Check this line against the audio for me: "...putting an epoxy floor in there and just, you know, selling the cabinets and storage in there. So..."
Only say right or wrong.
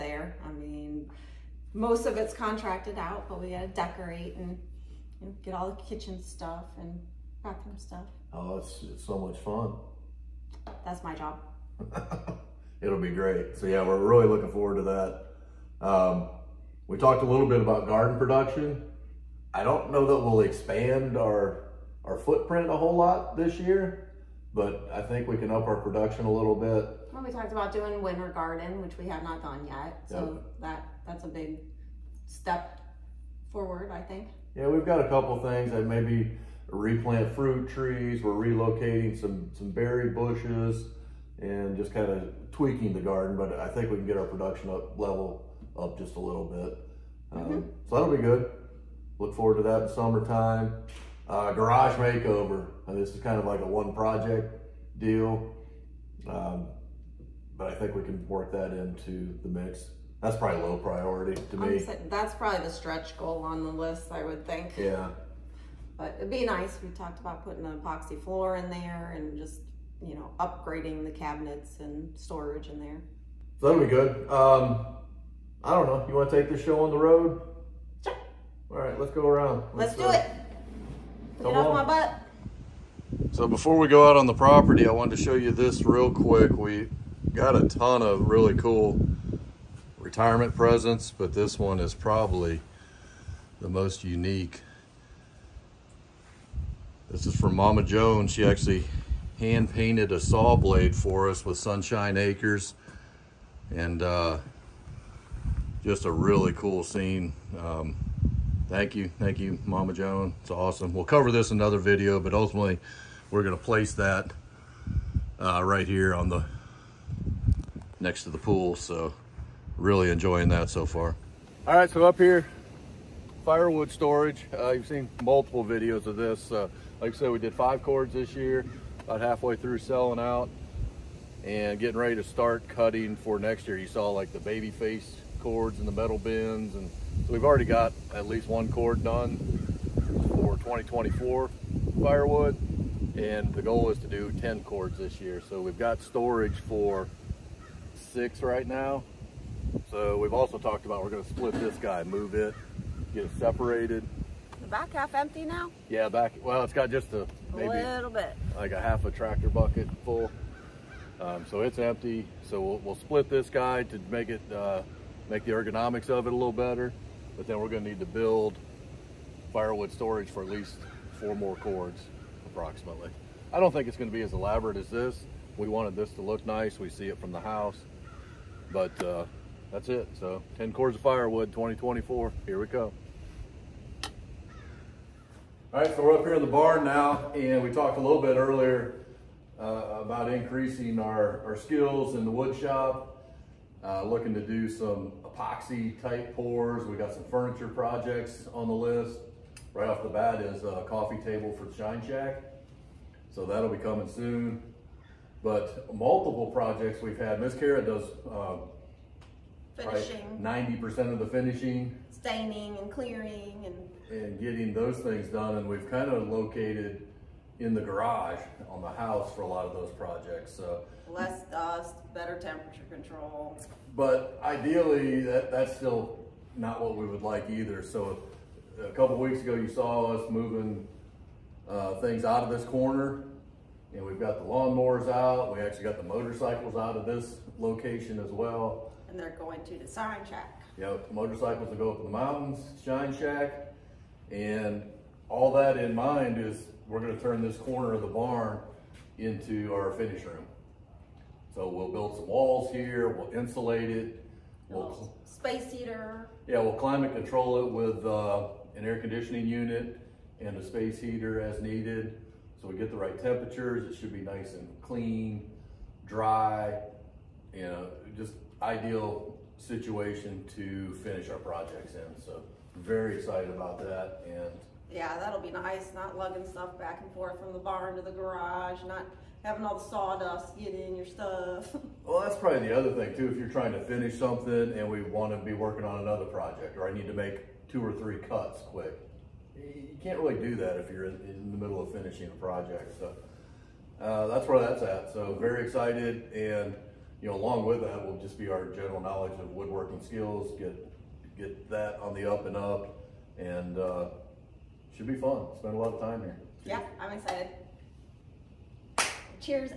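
wrong.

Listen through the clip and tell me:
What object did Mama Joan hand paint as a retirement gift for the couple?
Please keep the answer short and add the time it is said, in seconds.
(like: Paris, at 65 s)
saw blade, at 100 s.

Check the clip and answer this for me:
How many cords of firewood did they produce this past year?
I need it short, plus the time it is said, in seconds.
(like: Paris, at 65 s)
5, at 127 s.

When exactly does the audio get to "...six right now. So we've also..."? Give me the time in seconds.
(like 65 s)
147 s.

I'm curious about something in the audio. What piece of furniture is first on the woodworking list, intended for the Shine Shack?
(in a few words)
coffee table.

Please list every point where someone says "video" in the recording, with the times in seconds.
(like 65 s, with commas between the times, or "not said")
111 s, 125 s.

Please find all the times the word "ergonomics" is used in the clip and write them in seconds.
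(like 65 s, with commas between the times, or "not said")
165 s.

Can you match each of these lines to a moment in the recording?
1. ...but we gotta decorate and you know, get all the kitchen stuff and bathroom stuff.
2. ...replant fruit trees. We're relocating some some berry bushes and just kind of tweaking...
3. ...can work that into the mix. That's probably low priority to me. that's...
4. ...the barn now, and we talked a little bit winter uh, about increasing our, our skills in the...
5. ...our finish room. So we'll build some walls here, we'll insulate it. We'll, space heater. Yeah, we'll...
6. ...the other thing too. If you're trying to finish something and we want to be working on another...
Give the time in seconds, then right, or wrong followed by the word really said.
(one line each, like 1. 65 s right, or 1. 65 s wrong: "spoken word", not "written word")
1. 3 s right
2. 36 s right
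3. 58 s right
4. 186 s wrong: "earlier", not "winter"
5. 249 s right
6. 282 s right.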